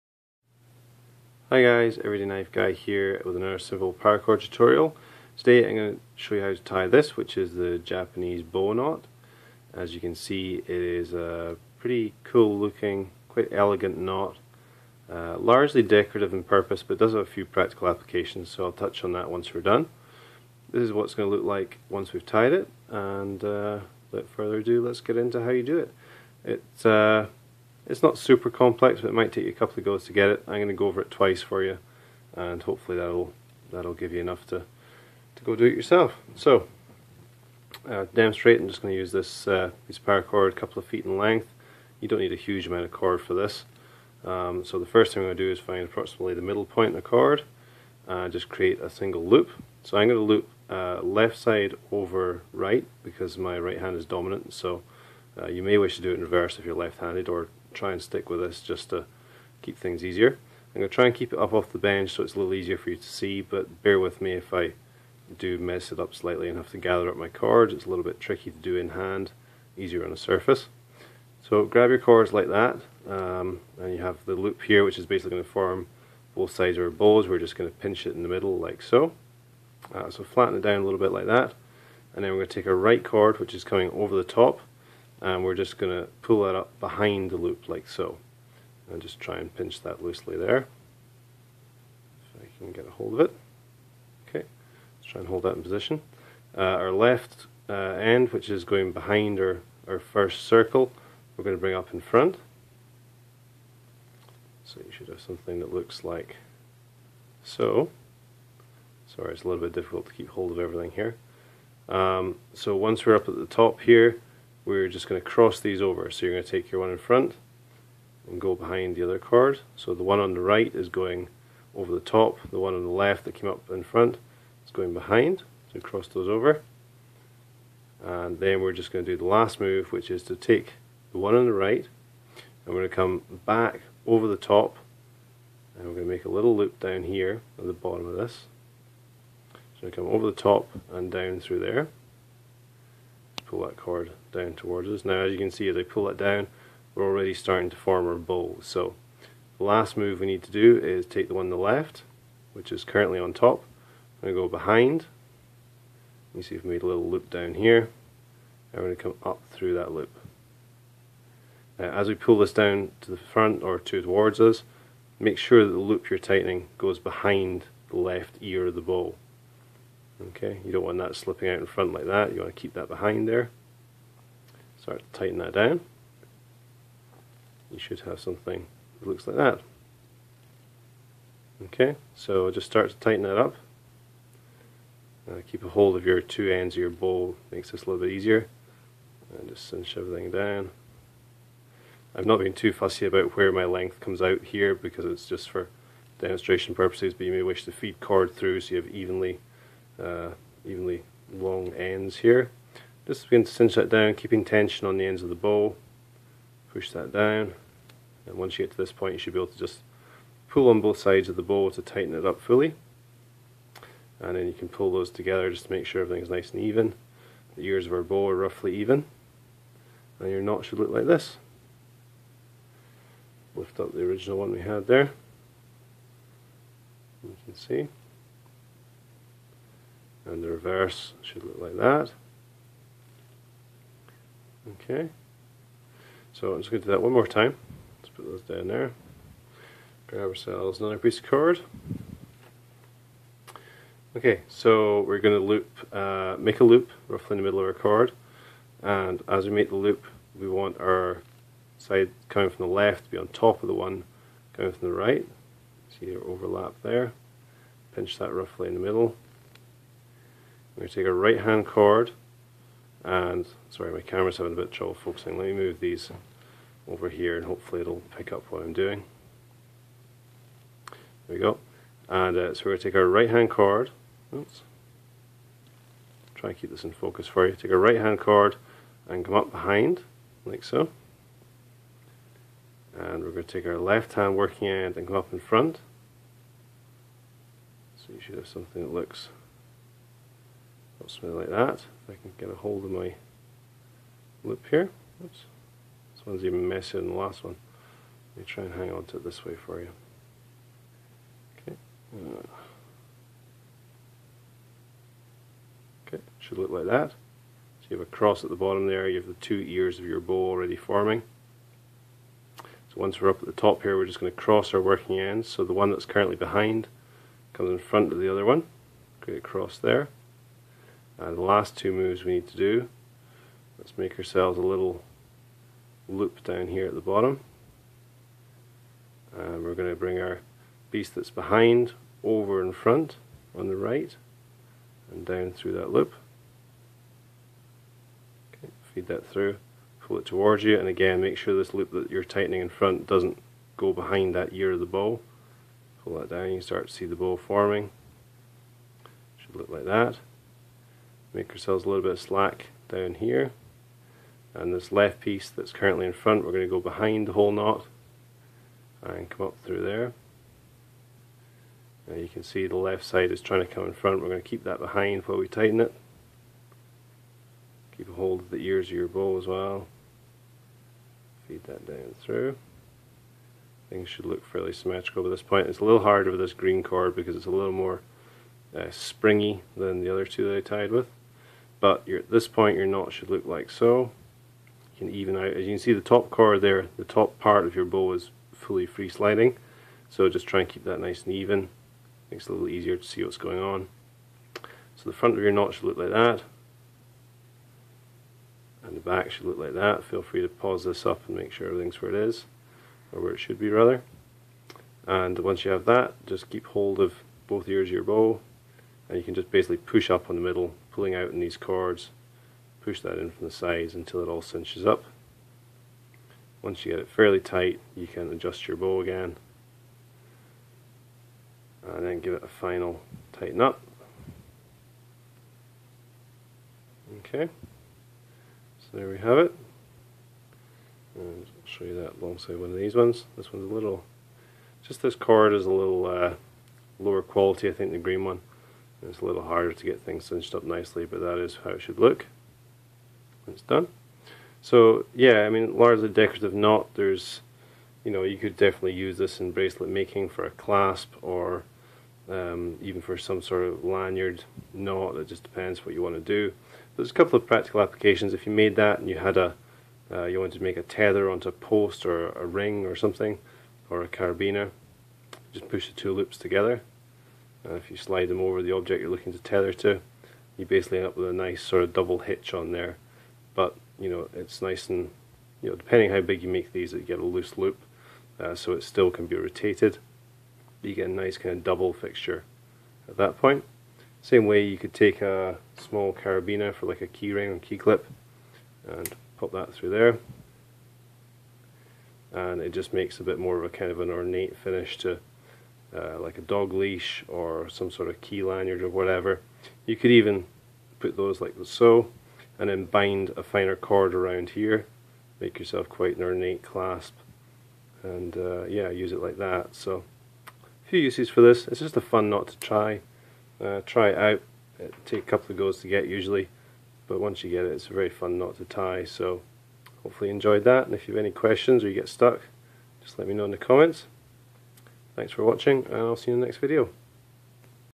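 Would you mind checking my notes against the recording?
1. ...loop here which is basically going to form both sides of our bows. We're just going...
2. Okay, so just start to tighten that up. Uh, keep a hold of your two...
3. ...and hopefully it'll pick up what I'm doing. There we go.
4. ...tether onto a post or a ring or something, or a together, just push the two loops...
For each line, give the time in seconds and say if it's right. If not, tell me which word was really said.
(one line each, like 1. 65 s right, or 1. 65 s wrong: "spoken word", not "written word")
1. 74 s right
2. 181 s right
3. 267 s right
4. 460 s wrong: "carabiner", not "together".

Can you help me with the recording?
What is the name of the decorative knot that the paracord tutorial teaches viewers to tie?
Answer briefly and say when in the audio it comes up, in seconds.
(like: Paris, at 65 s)
Japanese bow knot, at 7 s.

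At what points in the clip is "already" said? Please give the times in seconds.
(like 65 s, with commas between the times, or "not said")
147 s, 310 s.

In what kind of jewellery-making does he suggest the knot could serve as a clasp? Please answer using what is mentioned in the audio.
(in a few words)
bracelet making.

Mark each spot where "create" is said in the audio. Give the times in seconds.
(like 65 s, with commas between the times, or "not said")
48 s, 319 s.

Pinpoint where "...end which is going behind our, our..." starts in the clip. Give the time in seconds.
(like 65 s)
97 s.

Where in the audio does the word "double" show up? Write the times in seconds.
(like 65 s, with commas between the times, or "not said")
471 s, 481 s.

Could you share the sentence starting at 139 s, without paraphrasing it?
So come over the top and down through there pull that cord down towards us.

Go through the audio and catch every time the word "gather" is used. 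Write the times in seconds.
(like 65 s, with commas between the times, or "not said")
66 s.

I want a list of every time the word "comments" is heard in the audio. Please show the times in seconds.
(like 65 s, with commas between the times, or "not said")
523 s.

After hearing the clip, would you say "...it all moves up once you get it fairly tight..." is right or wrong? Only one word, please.
wrong.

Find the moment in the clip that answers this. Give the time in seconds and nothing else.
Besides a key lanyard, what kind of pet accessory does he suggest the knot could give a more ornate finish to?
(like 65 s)
496 s.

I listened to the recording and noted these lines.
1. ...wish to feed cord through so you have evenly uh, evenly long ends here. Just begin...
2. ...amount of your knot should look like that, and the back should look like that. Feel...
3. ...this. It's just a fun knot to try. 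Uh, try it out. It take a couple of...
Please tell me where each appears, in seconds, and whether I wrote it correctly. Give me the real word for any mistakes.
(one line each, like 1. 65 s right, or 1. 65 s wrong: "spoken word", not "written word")
1. 197 s right
2. 395 s wrong: "front", not "amount"
3. 511 s right.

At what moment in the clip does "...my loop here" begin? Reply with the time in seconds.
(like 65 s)
292 s.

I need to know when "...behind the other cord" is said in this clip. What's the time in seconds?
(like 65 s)
118 s.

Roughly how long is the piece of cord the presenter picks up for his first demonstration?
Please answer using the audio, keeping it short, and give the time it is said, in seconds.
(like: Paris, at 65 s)
a couple of feet, at 40 s.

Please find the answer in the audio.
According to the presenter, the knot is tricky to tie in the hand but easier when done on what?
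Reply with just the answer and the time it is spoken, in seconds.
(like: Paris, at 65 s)
a surface, at 69 s.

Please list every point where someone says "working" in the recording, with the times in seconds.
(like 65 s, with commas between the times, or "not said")
284 s, 314 s.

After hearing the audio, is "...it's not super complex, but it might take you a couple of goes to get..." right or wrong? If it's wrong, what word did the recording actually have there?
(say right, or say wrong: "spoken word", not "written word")
right.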